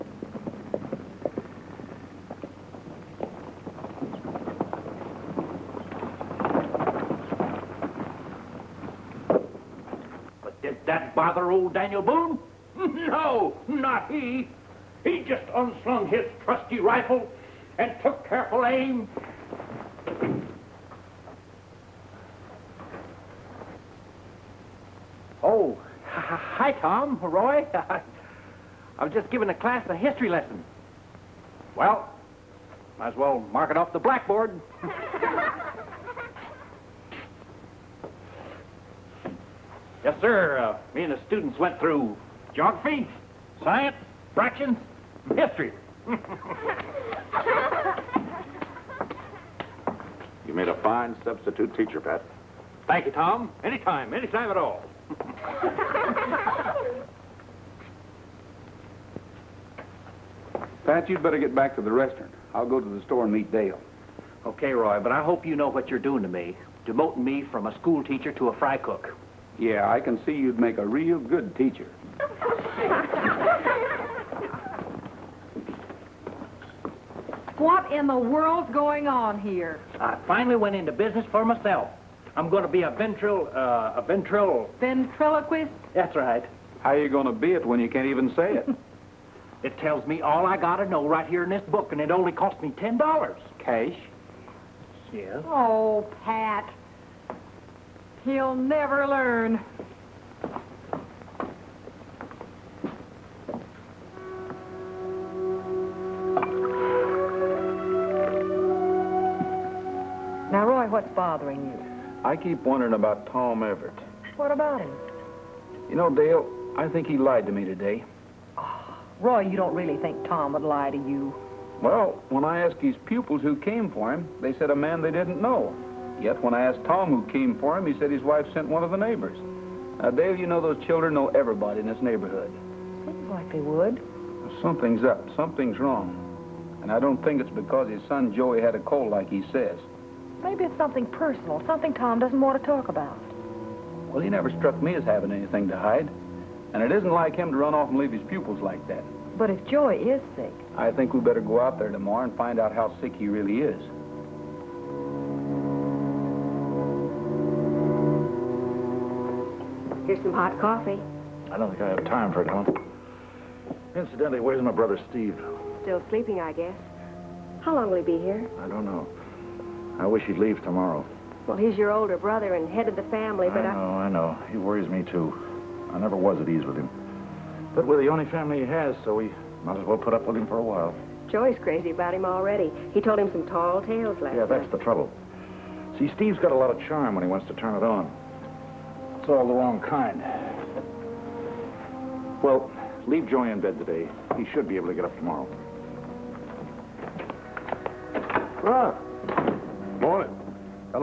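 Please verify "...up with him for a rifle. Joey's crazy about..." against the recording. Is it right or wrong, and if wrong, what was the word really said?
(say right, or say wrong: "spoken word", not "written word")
wrong: "while", not "rifle".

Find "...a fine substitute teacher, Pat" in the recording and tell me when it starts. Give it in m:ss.
0:50.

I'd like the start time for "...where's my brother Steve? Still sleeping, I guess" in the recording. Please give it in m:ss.
2:44.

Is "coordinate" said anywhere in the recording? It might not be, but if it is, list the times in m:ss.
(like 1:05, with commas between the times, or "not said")
not said.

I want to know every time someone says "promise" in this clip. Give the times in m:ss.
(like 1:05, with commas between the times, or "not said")
not said.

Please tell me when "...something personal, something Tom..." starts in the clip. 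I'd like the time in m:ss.
2:20.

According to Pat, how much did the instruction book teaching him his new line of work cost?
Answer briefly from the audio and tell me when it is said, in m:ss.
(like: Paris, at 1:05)
$10, at 1:32.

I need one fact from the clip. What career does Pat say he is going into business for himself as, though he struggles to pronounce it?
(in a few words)
Ventriloquist.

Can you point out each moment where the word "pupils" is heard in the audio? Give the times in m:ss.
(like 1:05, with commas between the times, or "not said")
2:03, 2:28.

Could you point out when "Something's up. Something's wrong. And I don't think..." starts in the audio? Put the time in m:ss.
2:14.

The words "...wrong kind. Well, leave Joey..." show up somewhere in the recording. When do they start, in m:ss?
3:09.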